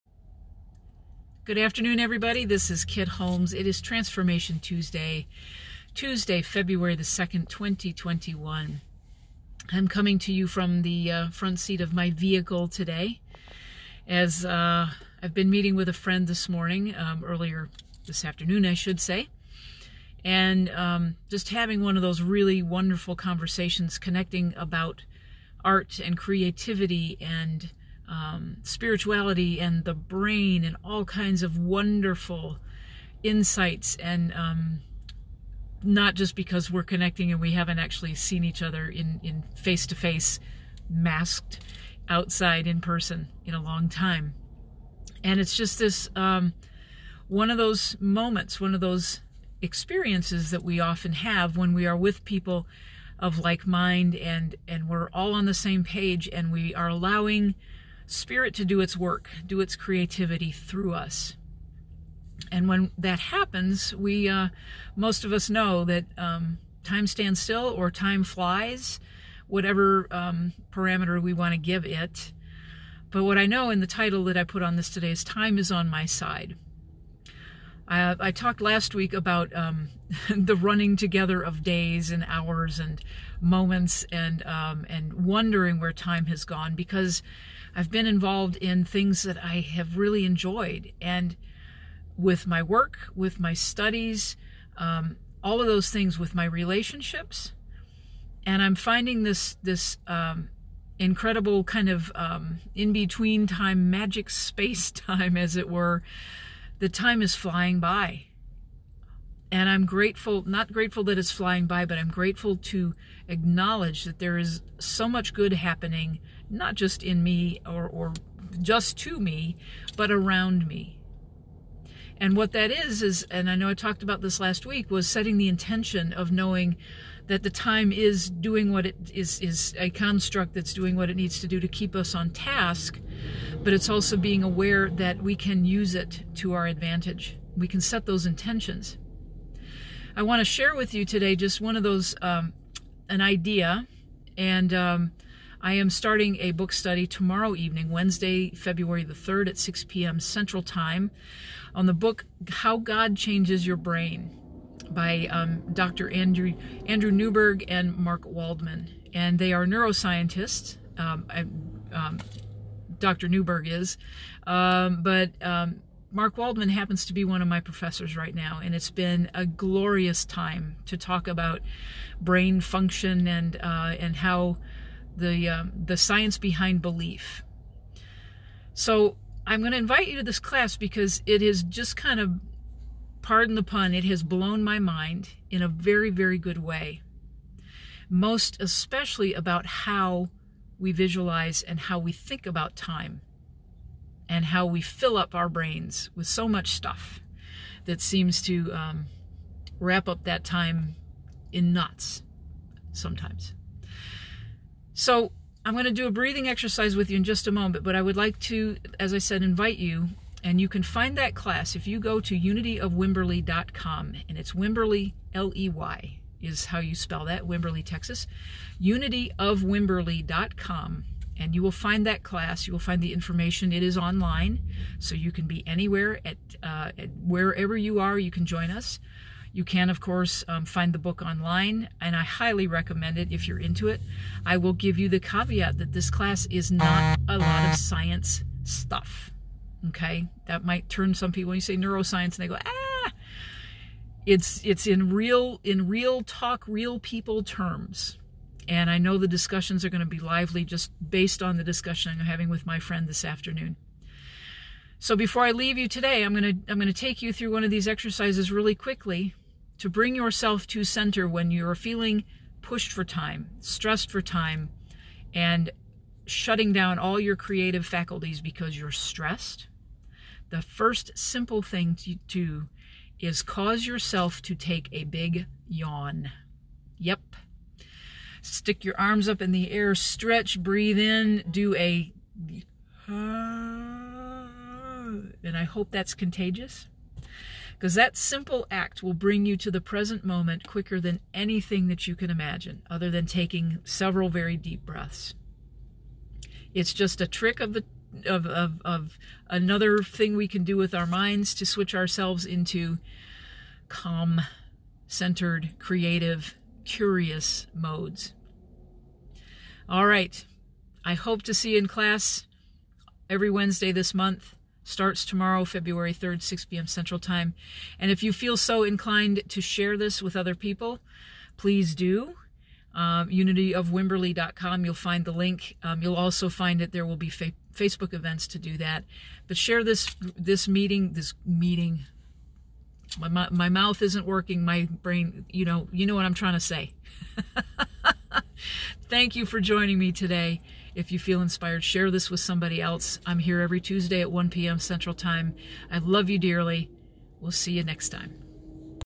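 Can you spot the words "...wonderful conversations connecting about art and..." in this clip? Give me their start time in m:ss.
0:22.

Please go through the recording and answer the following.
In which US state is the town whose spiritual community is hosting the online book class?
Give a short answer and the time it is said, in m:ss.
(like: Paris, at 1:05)
Texas, at 3:37.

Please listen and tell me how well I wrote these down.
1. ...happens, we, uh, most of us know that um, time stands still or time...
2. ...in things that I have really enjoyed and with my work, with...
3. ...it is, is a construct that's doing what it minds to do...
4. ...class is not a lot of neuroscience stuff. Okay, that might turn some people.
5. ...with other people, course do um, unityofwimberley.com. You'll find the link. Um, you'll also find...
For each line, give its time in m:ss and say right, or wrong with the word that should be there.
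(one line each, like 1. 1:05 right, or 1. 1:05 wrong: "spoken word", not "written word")
1. 1:03 right
2. 1:28 right
3. 2:08 wrong: "needs", not "minds"
4. 3:56 wrong: "science", not "neuroscience"
5. 5:20 wrong: "please", not "course".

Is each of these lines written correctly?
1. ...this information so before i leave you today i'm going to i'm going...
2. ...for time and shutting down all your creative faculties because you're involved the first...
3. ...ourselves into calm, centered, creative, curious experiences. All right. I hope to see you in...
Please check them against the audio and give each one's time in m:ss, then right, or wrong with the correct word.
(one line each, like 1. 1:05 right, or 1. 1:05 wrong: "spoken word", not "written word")
1. 4:13 wrong: "afternoon", not "information"
2. 4:24 wrong: "stressed", not "involved"
3. 5:01 wrong: "modes", not "experiences".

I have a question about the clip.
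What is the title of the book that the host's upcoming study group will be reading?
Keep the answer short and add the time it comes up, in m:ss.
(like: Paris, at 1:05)
How God Changes Your Brain, at 2:32.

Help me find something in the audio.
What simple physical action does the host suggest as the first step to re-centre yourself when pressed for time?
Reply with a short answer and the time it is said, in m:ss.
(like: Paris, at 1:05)
a big yawn, at 4:34.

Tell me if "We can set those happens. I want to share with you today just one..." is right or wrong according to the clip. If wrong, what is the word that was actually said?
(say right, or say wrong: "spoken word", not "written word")
wrong: "intentions", not "happens".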